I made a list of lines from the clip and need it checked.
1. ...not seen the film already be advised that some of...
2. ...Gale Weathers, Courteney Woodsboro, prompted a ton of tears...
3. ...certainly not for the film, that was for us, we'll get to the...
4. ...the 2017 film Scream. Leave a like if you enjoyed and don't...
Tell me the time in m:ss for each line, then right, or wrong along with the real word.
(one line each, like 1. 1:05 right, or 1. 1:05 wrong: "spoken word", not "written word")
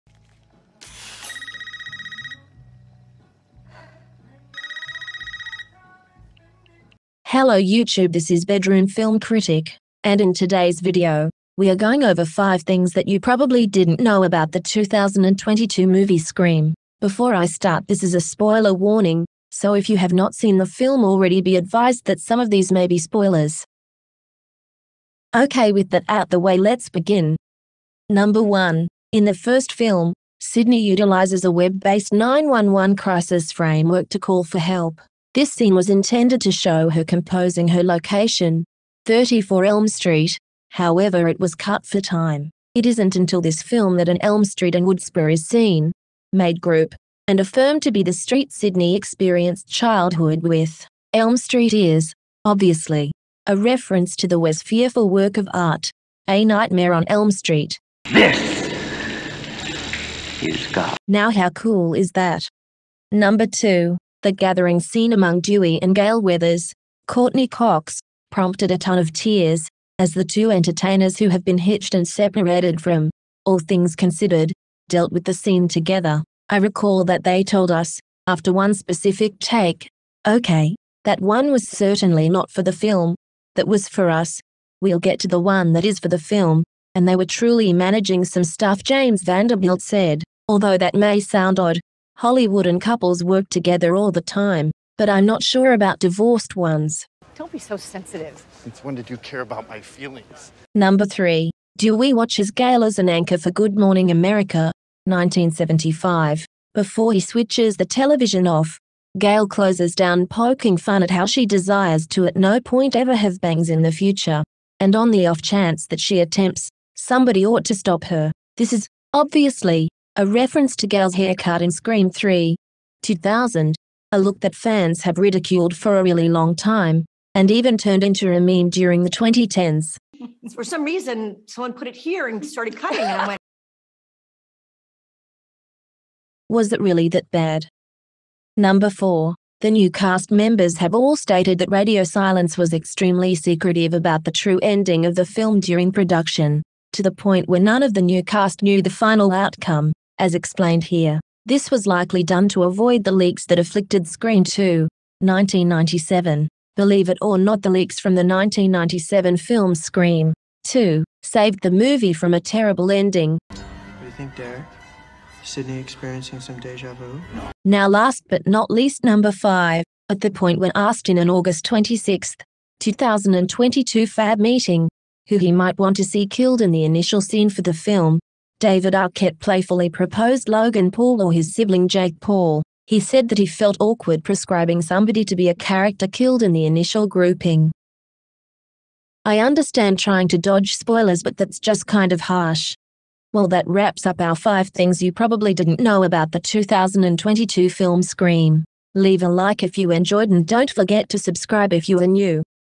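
1. 0:20 right
2. 1:05 wrong: "Cox", not "Woodsboro"
3. 1:21 right
4. 3:16 wrong: "2022", not "2017".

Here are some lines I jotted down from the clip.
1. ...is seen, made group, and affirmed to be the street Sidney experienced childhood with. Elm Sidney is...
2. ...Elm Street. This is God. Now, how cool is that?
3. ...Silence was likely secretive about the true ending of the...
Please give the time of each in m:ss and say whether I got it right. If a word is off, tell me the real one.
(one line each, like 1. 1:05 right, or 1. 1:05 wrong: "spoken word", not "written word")
1. 0:45 wrong: "Street", not "Sidney"
2. 0:57 right
3. 2:22 wrong: "extremely", not "likely".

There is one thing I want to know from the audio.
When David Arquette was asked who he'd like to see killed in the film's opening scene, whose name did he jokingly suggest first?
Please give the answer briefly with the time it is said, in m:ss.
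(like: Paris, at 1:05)
Logan Paul, at 3:00.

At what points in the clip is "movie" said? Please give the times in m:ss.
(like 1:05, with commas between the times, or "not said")
0:15, 2:41.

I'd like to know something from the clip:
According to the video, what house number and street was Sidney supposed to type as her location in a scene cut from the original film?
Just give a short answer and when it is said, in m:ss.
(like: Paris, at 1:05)
34 Elm Street, at 0:39.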